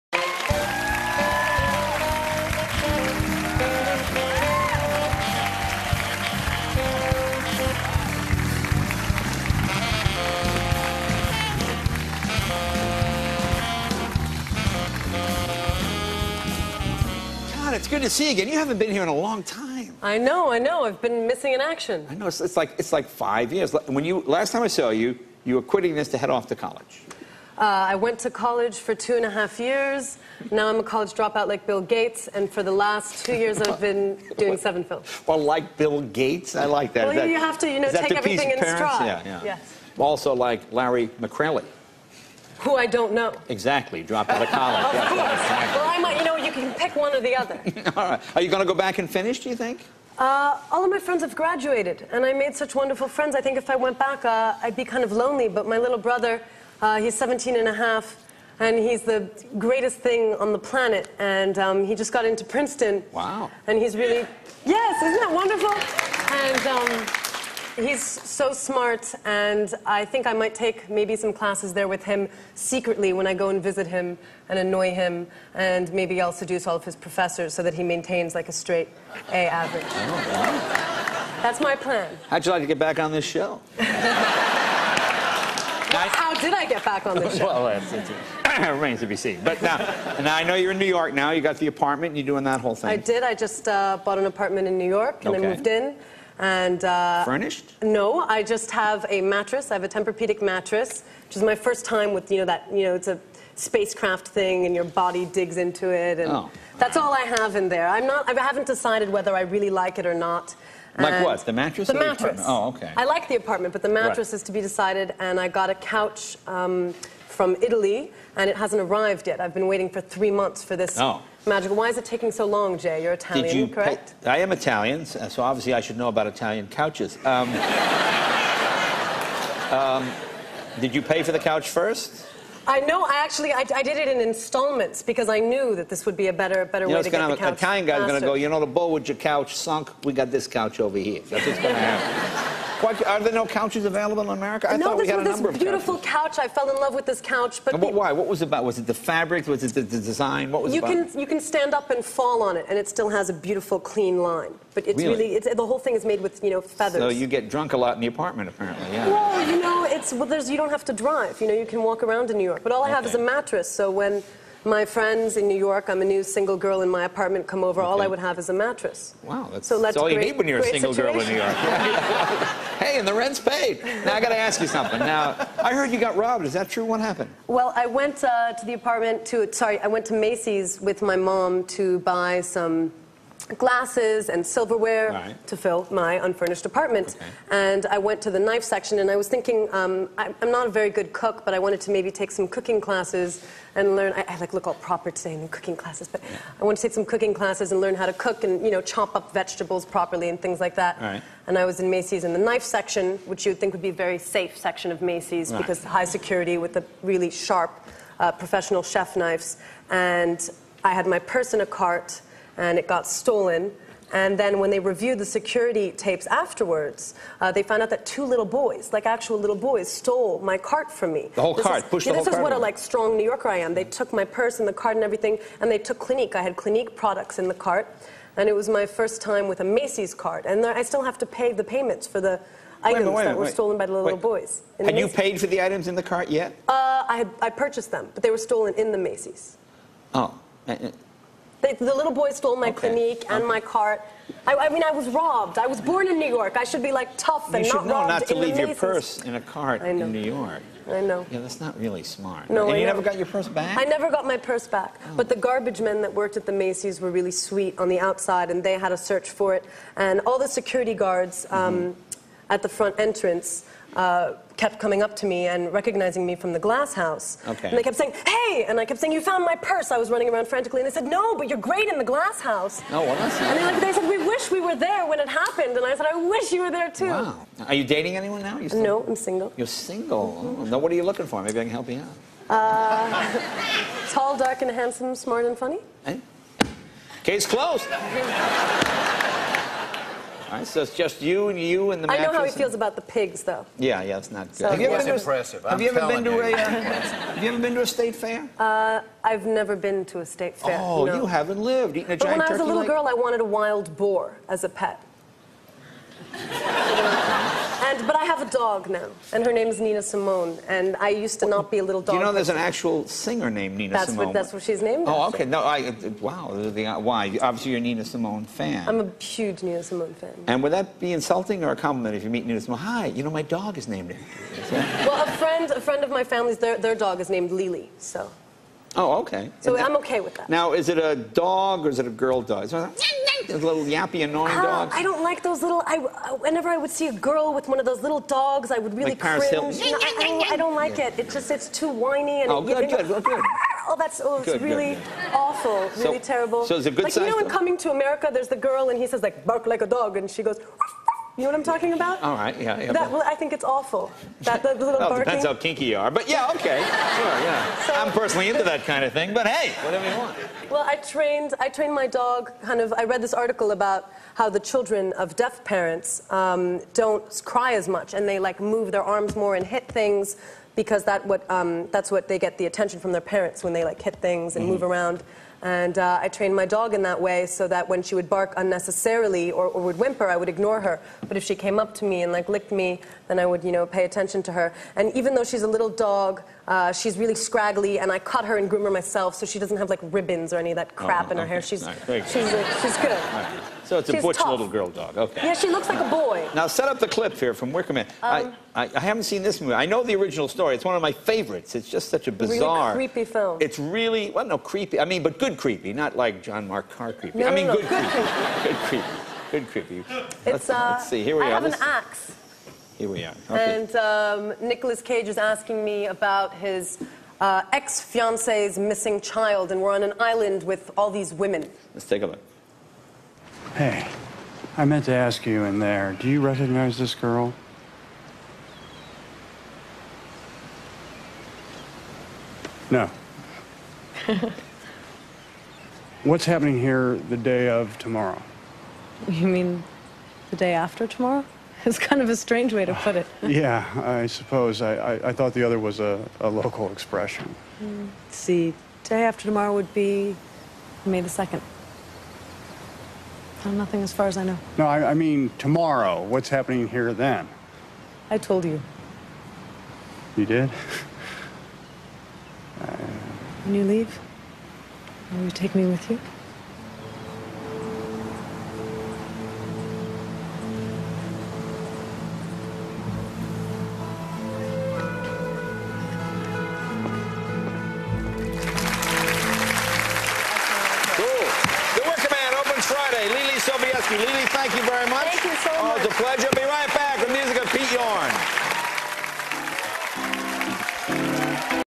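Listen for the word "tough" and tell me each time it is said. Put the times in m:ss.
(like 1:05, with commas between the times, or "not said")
4:07, 6:34.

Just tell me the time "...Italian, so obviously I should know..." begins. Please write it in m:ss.
2:04.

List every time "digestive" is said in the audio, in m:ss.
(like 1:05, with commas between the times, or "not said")
not said.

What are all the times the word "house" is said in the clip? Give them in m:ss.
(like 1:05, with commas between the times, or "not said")
4:26, 4:32.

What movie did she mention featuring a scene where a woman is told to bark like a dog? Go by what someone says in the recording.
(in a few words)
Coming to America.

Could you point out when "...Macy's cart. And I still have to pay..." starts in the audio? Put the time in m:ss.
3:49.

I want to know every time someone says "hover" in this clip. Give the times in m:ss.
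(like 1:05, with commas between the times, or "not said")
not said.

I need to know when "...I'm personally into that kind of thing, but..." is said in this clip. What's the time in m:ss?
5:57.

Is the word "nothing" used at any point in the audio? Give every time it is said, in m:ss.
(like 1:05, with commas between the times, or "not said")
7:33.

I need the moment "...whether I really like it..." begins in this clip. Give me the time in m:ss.
1:49.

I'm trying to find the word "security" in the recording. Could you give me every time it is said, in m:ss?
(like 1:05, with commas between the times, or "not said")
3:26, 3:35, 4:20.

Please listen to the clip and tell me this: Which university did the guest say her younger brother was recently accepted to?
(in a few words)
Princeton.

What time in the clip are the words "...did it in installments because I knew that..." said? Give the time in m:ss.
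2:13.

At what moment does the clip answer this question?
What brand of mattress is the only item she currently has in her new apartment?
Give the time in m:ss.
1:39.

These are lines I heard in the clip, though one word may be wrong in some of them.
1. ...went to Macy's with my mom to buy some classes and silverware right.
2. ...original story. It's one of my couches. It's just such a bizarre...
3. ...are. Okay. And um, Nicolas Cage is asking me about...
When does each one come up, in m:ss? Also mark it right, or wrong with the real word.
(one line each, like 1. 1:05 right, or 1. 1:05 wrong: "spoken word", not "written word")
1. 2:59 wrong: "glasses", not "classes"
2. 6:40 wrong: "favorites", not "couches"
3. 6:53 right.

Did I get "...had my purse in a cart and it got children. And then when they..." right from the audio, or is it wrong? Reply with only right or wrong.
wrong.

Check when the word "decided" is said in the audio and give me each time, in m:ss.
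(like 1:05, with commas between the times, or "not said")
1:48, 1:54.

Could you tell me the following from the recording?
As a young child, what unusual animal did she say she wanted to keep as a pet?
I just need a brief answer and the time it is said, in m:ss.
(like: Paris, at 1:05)
A wild boar, at 5:03.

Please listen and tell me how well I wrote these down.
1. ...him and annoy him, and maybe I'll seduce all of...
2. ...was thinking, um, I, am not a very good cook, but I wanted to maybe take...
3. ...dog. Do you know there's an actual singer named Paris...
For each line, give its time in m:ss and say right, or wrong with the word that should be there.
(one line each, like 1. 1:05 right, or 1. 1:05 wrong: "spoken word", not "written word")
1. 1:13 right
2. 3:09 right
3. 5:12 wrong: "Nina", not "Paris".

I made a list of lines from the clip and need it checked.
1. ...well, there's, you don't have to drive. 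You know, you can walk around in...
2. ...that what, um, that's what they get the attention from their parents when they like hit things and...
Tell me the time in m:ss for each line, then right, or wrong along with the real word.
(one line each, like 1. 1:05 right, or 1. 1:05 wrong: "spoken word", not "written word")
1. 2:40 right
2. 6:11 right.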